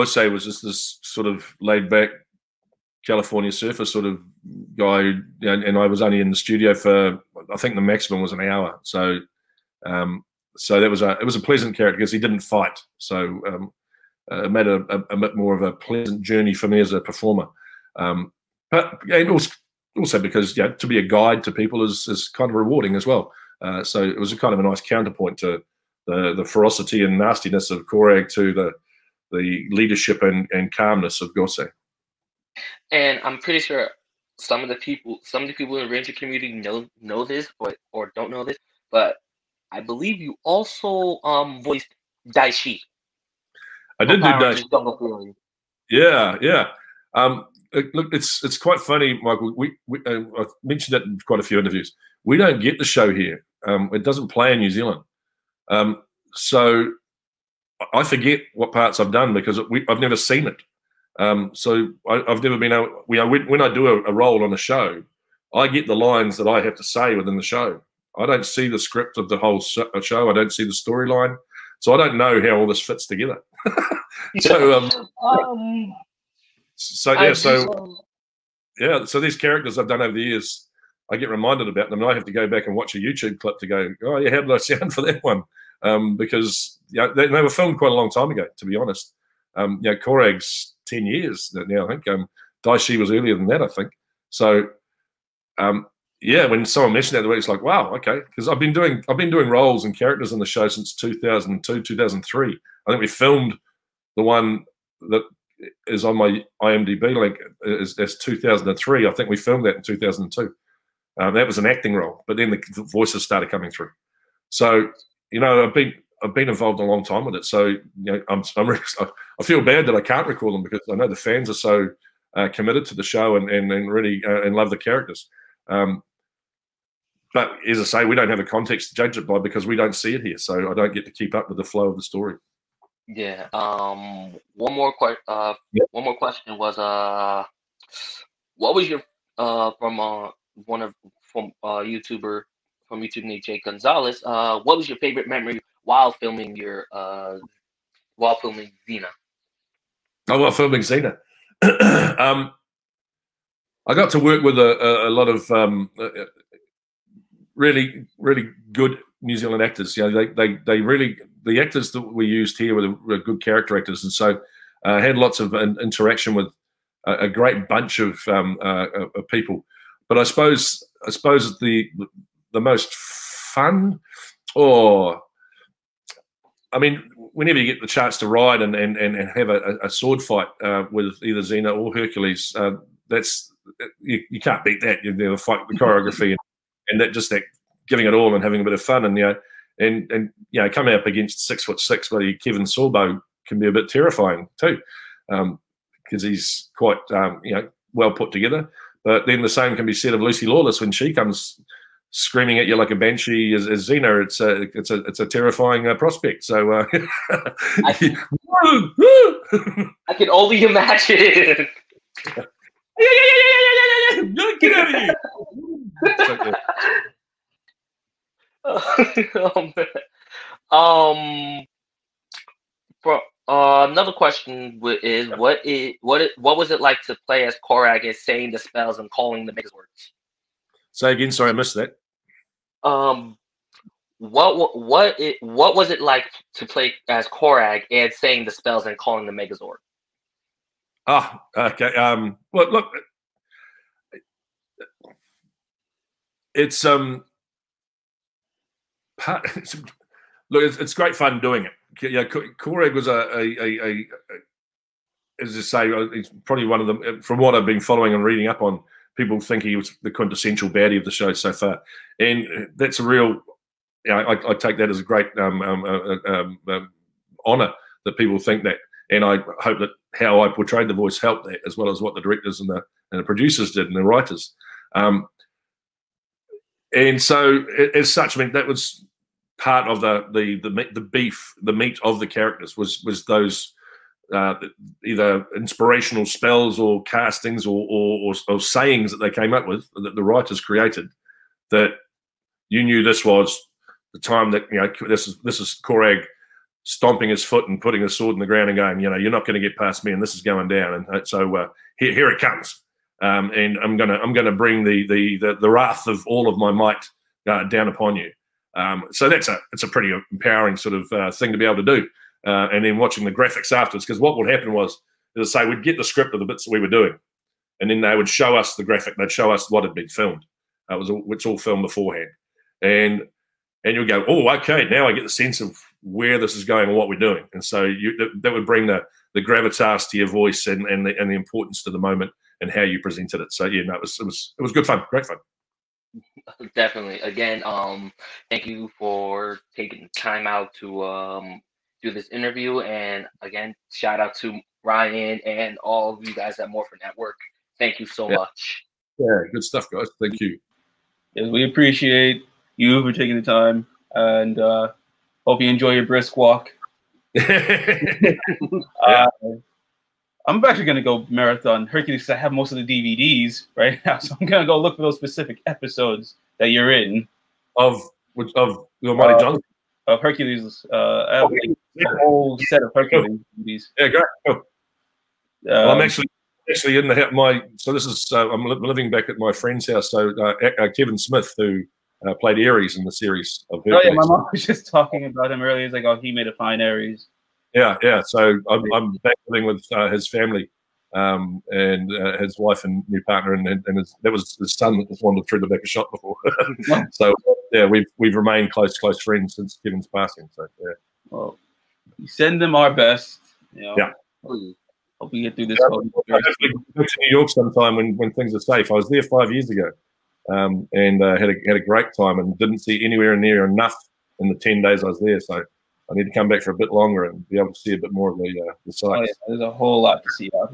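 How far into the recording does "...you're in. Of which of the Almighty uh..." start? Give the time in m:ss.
6:06.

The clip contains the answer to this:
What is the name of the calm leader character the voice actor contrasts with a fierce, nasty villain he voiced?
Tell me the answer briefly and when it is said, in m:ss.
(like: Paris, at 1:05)
Gosei, at 0:31.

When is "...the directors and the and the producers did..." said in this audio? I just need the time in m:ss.
4:32.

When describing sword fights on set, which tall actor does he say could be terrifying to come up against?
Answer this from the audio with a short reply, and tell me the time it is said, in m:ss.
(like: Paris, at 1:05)
Kevin Sorbo, at 3:12.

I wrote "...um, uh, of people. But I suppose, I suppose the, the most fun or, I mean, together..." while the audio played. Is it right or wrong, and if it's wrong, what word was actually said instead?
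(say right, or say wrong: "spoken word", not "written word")
wrong: "whenever", not "together".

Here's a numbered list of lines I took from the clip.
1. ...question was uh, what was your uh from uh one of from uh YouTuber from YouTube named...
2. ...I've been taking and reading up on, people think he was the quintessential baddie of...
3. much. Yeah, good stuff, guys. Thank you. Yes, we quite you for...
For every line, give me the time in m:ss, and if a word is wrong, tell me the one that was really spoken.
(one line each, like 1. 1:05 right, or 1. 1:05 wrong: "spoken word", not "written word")
1. 2:16 right
2. 4:17 wrong: "following", not "taking"
3. 5:48 wrong: "appreciate", not "quite".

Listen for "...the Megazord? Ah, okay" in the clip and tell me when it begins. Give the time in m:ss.
3:59.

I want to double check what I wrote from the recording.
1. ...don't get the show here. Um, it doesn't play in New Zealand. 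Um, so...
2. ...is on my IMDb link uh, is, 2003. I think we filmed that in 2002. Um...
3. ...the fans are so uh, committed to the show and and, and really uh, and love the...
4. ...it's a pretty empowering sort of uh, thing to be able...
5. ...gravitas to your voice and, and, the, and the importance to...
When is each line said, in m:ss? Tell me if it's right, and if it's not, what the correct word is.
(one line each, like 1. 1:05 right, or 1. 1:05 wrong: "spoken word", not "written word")
1. 0:52 right
2. 1:45 right
3. 2:01 right
4. 5:09 right
5. 5:29 right.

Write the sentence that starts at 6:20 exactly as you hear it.
So uh, uh Kevin Smith, who uh, played Ares in the series of.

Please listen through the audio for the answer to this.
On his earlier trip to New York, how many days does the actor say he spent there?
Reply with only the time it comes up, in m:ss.
6:54.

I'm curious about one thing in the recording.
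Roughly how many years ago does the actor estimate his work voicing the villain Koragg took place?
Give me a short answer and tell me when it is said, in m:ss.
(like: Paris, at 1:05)
10, at 1:30.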